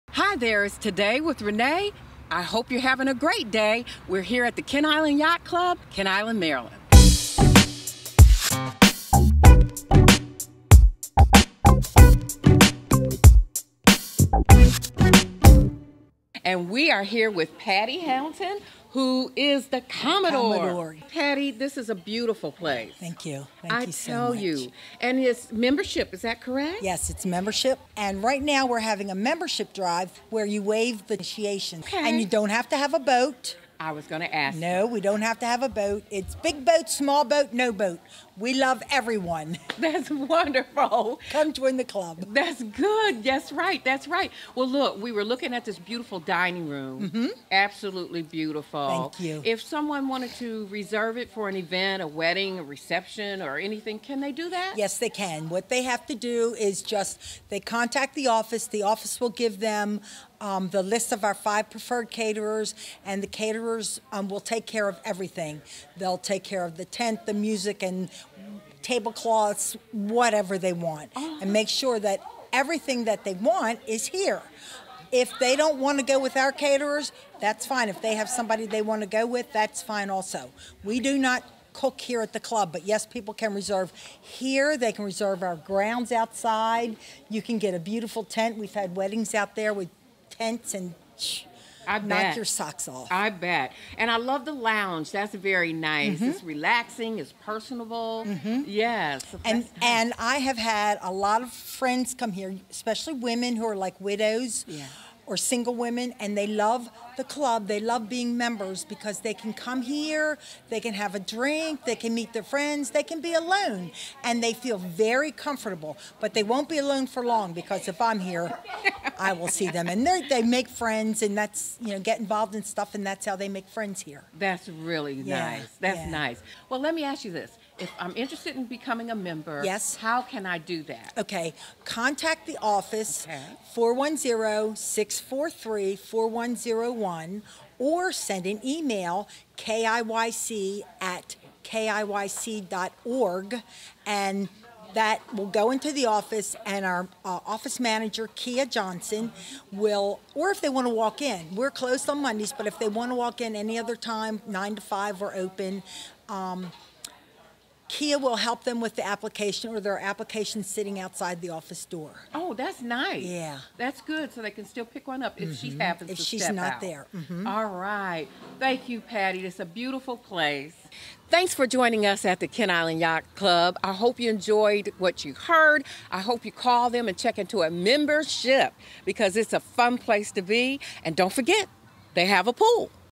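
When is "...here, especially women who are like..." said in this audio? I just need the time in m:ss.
1:42.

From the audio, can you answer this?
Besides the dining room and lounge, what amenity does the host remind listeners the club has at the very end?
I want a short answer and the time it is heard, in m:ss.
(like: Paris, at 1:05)
a pool, at 3:02.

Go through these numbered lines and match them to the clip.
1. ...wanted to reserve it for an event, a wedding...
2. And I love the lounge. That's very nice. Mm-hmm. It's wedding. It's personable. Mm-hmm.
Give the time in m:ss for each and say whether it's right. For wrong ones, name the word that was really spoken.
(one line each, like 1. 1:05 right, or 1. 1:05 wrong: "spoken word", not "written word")
1. 0:50 right
2. 1:33 wrong: "relaxing", not "wedding".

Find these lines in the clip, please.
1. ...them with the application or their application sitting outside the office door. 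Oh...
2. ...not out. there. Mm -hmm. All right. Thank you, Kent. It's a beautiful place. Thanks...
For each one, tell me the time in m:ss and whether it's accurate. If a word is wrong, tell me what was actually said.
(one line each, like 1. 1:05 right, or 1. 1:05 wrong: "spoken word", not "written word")
1. 2:38 right
2. 2:46 wrong: "Patty", not "Kent".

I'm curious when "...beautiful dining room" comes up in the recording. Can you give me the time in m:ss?
0:45.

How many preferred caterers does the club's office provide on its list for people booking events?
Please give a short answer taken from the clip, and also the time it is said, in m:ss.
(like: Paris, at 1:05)
5, at 1:01.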